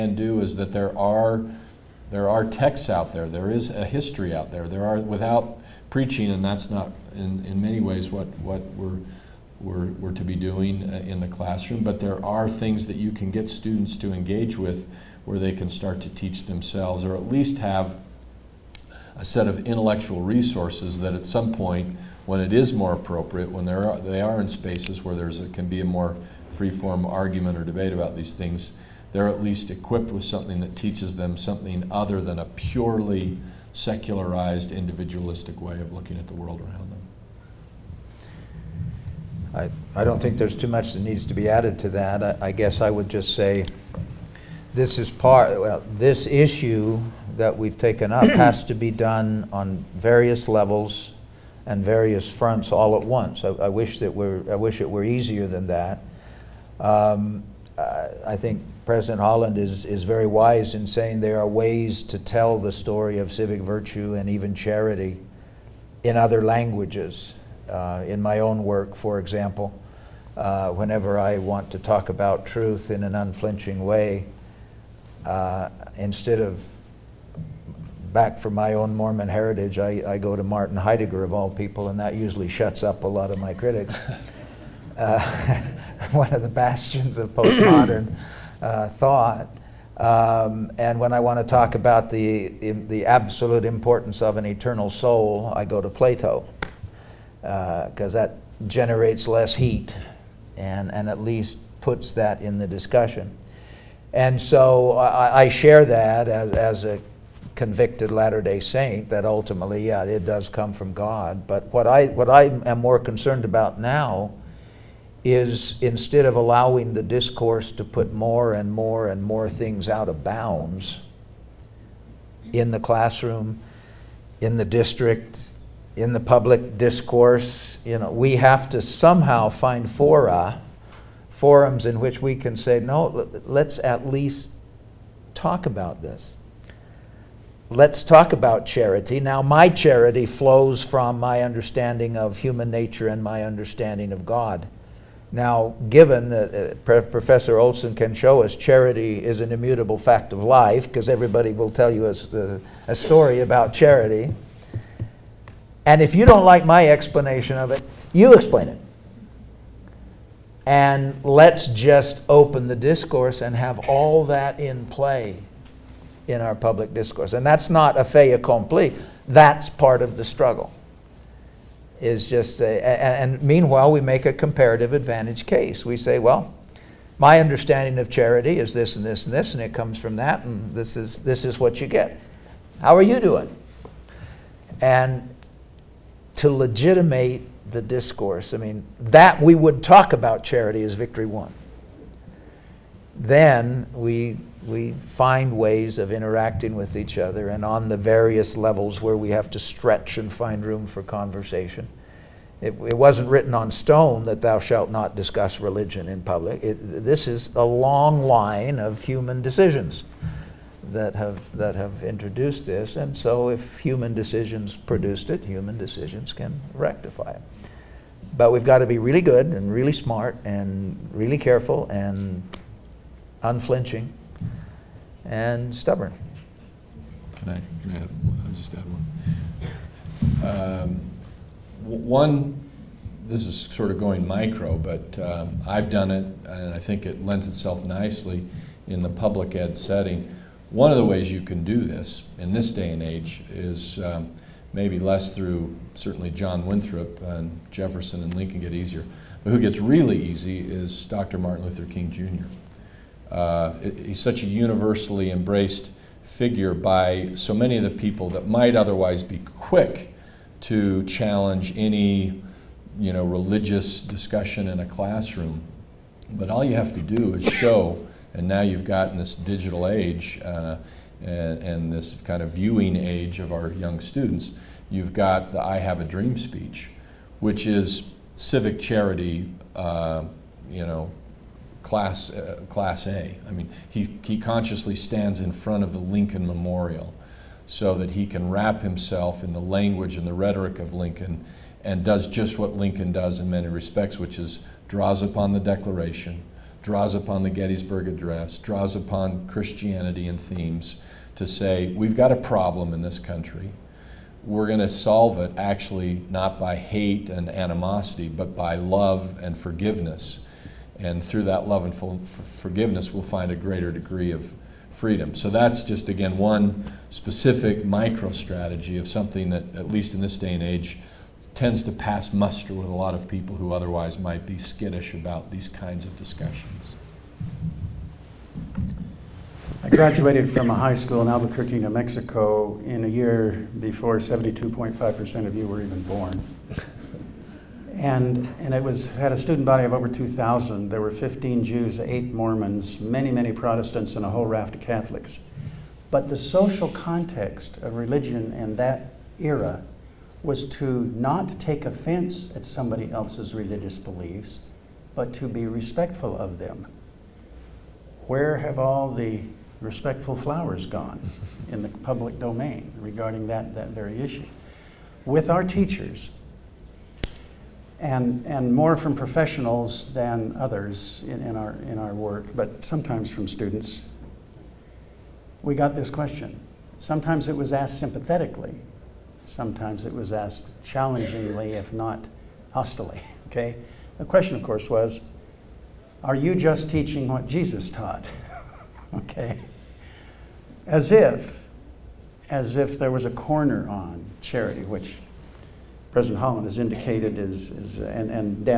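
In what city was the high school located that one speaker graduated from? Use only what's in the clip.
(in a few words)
Albuquerque.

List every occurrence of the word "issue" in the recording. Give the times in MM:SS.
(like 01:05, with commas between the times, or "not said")
00:46, 06:04.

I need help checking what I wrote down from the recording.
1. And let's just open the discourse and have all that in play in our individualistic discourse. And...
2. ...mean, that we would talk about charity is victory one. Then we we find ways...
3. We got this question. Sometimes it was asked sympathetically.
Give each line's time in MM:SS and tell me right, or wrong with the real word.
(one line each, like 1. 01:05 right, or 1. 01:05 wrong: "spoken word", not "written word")
1. 02:40 wrong: "public", not "individualistic"
2. 03:08 right
3. 06:15 right.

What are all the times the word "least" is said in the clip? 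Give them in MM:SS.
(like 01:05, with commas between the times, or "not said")
00:17, 00:29, 01:41, 02:14, 05:19.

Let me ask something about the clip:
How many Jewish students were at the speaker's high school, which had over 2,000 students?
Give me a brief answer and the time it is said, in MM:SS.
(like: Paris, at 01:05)
15, at 05:41.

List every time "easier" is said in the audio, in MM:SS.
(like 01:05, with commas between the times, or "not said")
00:55, 04:08.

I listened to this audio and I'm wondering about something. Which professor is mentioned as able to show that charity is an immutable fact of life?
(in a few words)
Professor Olson.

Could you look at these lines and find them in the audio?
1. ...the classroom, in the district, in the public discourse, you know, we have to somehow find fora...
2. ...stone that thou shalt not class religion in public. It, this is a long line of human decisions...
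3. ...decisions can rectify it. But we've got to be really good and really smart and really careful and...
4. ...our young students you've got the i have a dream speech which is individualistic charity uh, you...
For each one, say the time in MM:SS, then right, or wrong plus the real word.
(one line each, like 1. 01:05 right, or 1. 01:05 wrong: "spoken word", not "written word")
1. 02:02 right
2. 03:23 wrong: "discuss", not "class"
3. 03:35 right
4. 04:33 wrong: "civic", not "individualistic".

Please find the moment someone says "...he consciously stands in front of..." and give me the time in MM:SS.
04:44.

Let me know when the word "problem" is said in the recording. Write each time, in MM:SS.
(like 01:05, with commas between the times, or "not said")
05:02.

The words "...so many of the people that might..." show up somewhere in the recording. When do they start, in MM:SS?
04:17.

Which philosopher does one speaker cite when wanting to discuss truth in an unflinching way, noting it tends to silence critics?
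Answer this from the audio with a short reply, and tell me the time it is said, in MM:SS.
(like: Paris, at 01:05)
Martin Heidegger, at 01:20.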